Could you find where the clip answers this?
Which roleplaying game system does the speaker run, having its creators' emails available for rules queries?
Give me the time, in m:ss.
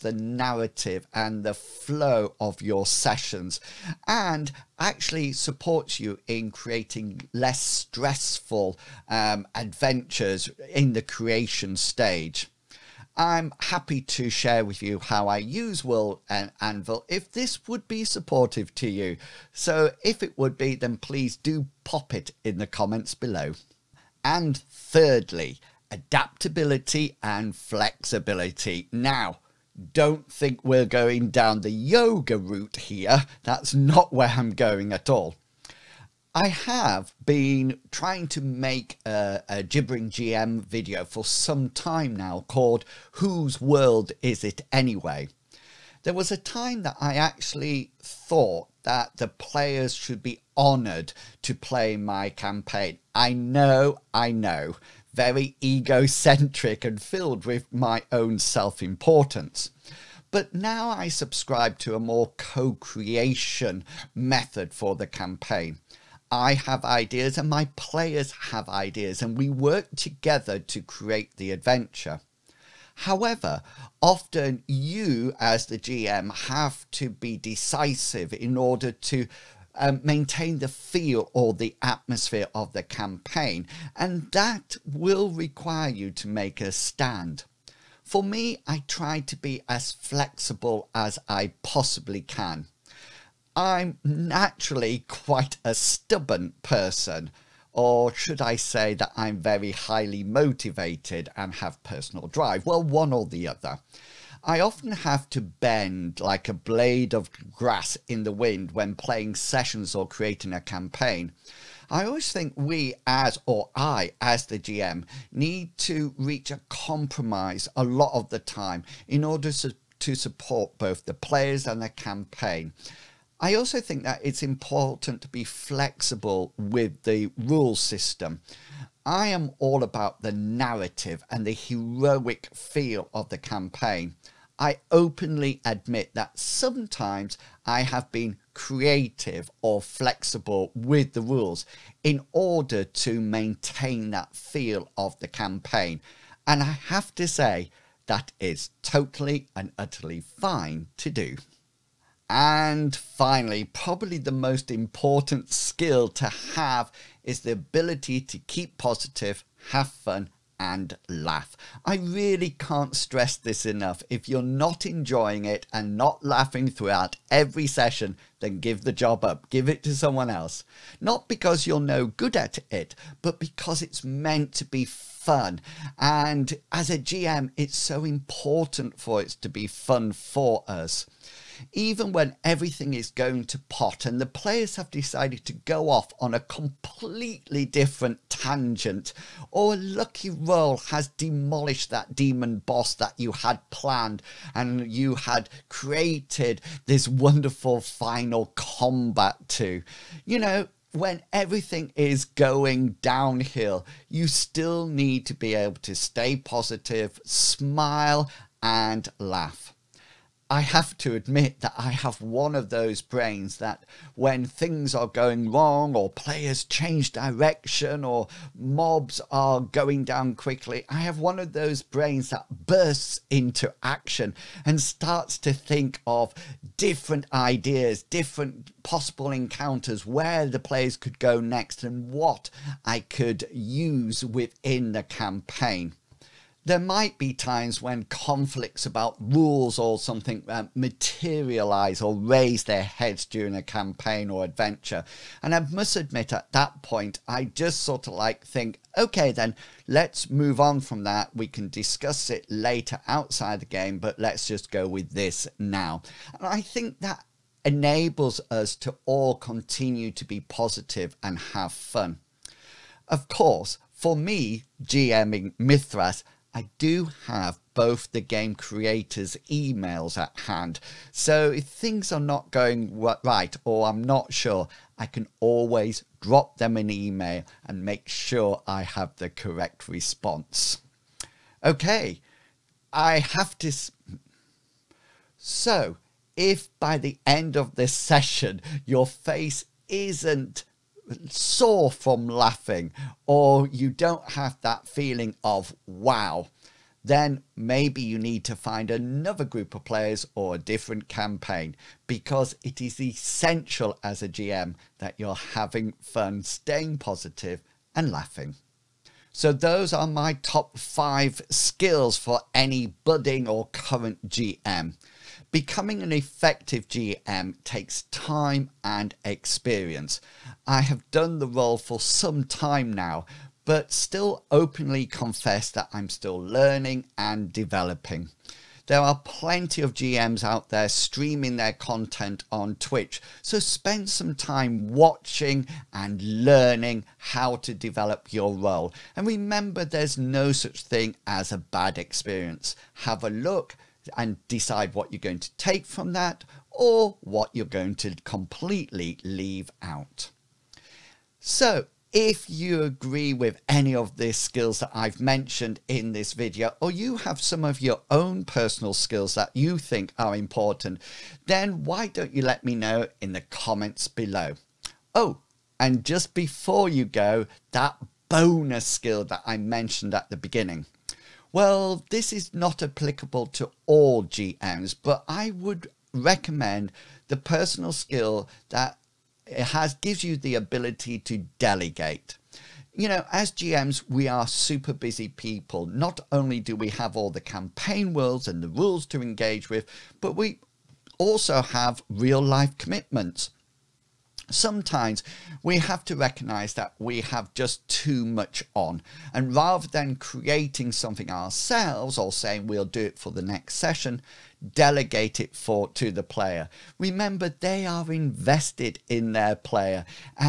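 4:25.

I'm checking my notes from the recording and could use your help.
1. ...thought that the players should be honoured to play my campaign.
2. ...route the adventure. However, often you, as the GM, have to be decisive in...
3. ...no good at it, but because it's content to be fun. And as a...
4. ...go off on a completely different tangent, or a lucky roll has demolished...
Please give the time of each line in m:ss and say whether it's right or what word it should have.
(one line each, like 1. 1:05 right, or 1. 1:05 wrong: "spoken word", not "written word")
1. 0:48 right
2. 1:10 wrong: "create", not "route"
3. 2:51 wrong: "meant", not "content"
4. 3:05 right.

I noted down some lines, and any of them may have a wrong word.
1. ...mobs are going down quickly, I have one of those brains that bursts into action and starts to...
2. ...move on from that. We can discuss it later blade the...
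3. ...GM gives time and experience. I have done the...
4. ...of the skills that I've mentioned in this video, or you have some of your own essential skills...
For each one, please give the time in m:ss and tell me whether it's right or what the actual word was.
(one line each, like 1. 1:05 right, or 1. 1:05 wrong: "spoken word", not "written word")
1. 3:38 right
2. 4:10 wrong: "outside", not "blade"
3. 5:16 wrong: "takes", not "gives"
4. 5:53 wrong: "personal", not "essential".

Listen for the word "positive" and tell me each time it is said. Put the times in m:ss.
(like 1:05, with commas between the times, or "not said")
2:38, 3:26, 4:20, 5:06.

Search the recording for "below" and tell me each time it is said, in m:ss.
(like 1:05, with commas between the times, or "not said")
0:23, 6:04.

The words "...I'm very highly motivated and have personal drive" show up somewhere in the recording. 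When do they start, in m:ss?
1:39.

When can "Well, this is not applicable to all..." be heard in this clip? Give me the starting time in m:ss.
6:11.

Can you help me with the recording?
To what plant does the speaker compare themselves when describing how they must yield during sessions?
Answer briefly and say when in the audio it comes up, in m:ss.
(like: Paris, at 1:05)
A blade of grass, at 1:46.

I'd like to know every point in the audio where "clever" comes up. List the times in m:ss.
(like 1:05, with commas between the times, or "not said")
not said.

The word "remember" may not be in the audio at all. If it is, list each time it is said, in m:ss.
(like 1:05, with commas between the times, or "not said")
5:39, 6:46.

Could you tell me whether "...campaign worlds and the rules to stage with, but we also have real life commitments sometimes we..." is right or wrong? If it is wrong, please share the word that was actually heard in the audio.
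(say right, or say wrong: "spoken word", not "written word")
wrong: "engage", not "stage".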